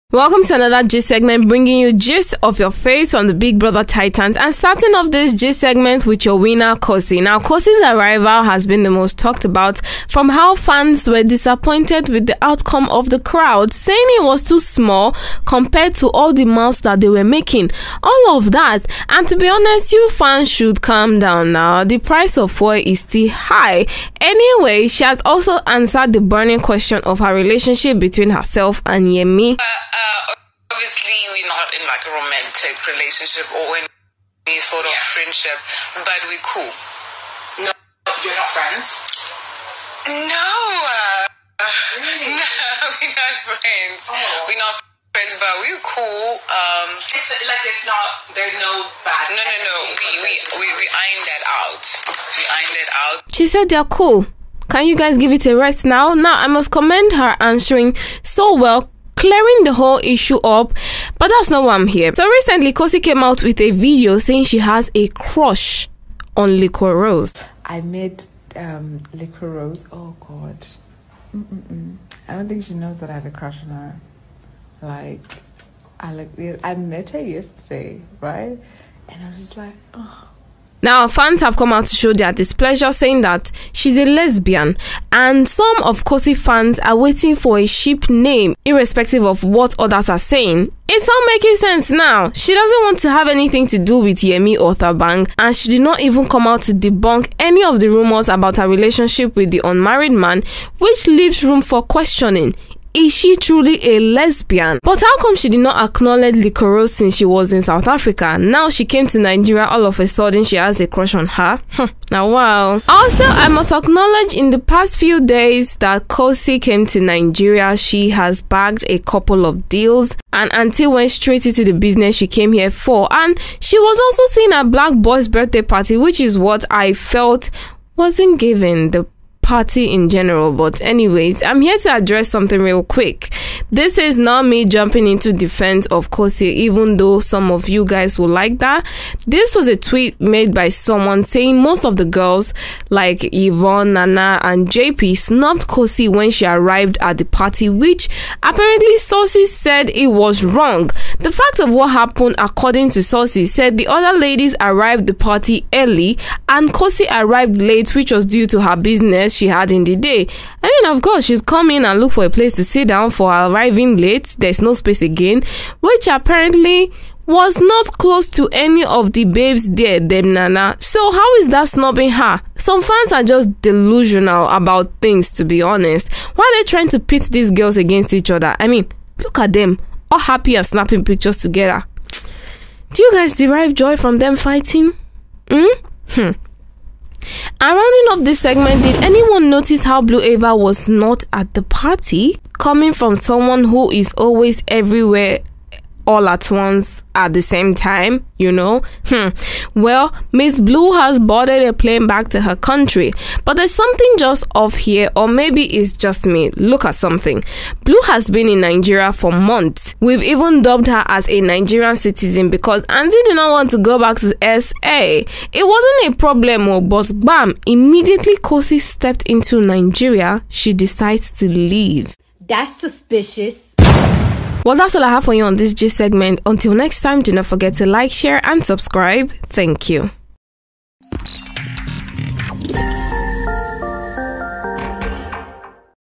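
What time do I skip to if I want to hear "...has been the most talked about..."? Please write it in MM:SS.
00:08.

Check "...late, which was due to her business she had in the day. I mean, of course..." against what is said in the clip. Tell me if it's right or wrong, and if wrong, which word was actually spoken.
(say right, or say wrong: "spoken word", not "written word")
right.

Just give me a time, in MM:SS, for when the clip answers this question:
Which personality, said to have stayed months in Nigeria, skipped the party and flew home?
03:10.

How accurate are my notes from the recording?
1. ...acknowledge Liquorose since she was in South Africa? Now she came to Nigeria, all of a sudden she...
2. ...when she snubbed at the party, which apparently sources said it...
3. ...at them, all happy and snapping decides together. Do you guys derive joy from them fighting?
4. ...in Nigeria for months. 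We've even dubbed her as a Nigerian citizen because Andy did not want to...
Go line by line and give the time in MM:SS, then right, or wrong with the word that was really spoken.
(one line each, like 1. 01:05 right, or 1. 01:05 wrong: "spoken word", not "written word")
1. 01:45 right
2. 02:26 wrong: "arrived", not "snubbed"
3. 02:59 wrong: "pictures", not "decides"
4. 03:28 right.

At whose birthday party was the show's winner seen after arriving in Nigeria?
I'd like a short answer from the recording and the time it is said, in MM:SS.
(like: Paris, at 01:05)
Black Boy, at 02:04.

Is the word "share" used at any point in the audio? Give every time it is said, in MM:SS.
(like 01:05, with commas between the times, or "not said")
03:48.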